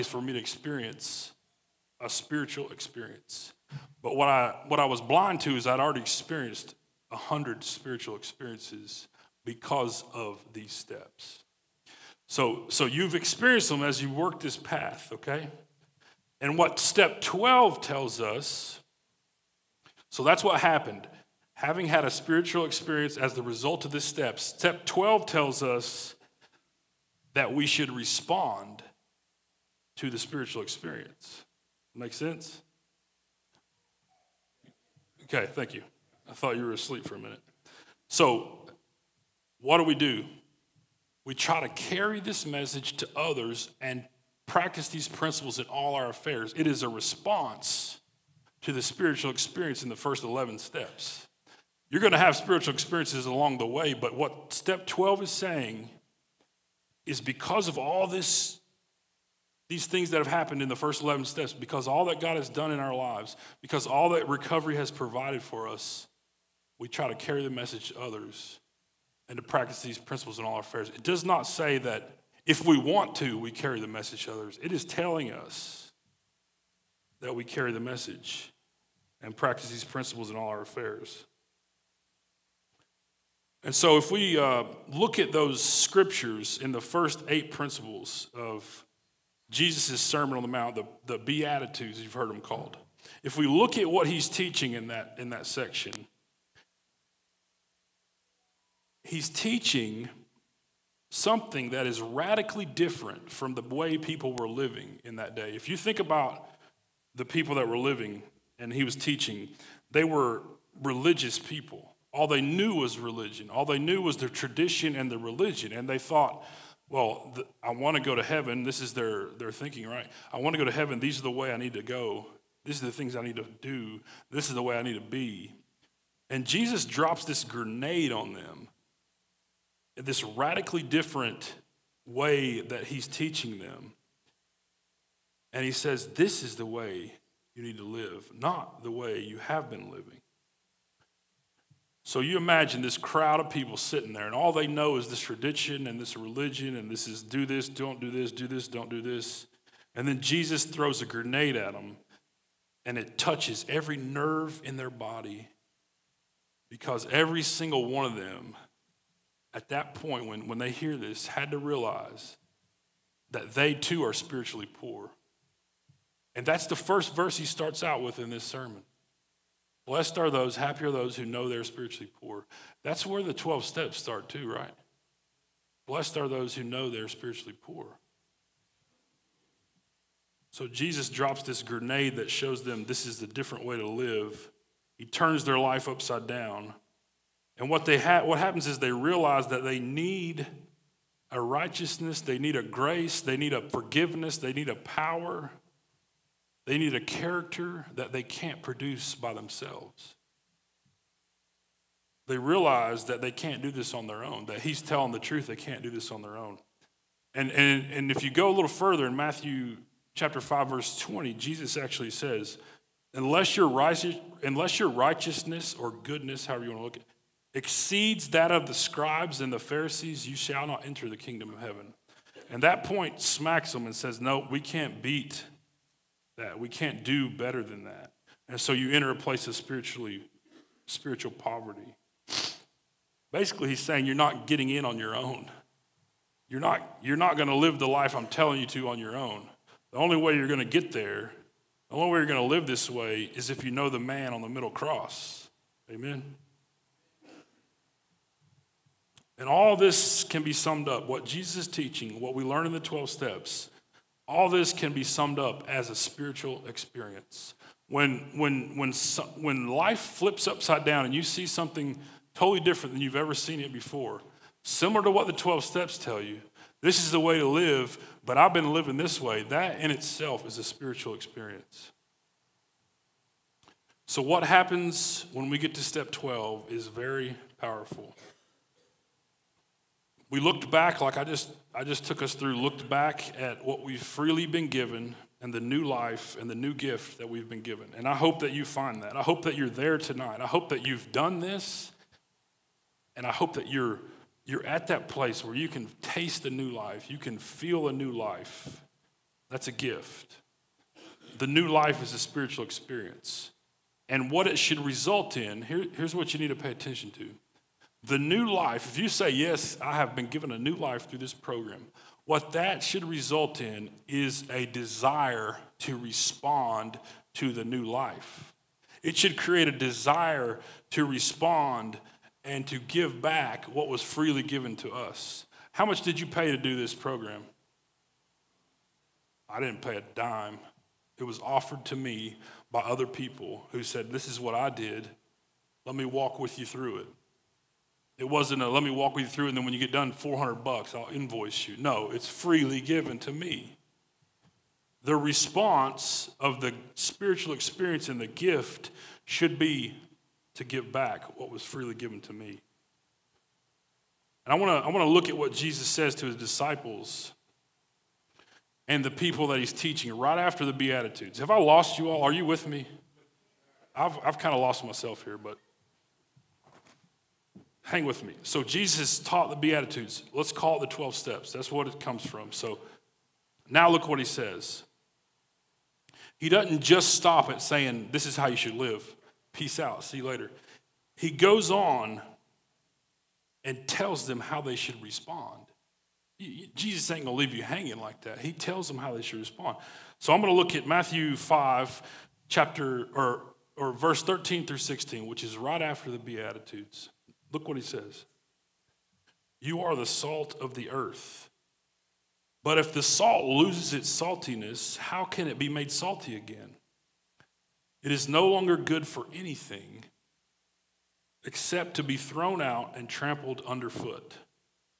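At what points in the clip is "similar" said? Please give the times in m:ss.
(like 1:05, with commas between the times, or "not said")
4:24.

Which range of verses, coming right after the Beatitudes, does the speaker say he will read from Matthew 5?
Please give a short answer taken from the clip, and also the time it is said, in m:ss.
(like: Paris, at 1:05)
13 through 16, at 6:34.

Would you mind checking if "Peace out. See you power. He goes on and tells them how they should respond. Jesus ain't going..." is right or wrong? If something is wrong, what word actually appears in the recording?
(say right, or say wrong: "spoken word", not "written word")
wrong: "later", not "power".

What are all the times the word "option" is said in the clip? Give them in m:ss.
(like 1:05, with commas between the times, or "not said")
not said.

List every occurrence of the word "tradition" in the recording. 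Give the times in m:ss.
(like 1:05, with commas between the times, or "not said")
1:54, 2:25.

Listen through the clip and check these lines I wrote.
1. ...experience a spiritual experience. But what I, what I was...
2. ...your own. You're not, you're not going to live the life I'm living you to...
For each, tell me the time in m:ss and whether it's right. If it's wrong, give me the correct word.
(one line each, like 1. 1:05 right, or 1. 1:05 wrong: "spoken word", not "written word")
1. 0:00 right
2. 3:54 wrong: "telling", not "living".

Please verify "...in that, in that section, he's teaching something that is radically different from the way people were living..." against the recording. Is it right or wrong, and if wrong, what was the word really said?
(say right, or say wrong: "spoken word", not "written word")
right.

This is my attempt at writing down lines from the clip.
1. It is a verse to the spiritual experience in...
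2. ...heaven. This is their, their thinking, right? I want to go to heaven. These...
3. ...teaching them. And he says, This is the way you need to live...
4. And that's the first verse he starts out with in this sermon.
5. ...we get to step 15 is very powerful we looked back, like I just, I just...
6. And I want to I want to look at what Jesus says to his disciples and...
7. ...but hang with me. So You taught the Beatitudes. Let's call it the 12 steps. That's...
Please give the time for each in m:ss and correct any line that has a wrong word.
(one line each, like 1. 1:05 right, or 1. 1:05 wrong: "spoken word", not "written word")
1. 0:46 wrong: "response", not "verse"
2. 1:58 right
3. 2:13 right
4. 2:46 right
5. 4:35 wrong: "12", not "15"
6. 5:54 right
7. 6:05 wrong: "Jesus", not "You".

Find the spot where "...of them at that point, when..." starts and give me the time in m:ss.
2:38.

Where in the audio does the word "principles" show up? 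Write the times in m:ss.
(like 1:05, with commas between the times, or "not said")
0:45, 1:09, 1:19, 1:27.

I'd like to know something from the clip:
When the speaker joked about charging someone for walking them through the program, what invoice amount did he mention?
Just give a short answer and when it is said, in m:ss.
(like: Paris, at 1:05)
$400, at 5:40.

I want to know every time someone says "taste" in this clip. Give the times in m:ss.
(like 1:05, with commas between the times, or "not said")
4:56.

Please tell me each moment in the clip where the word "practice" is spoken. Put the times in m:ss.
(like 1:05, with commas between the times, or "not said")
0:44, 1:09, 1:19.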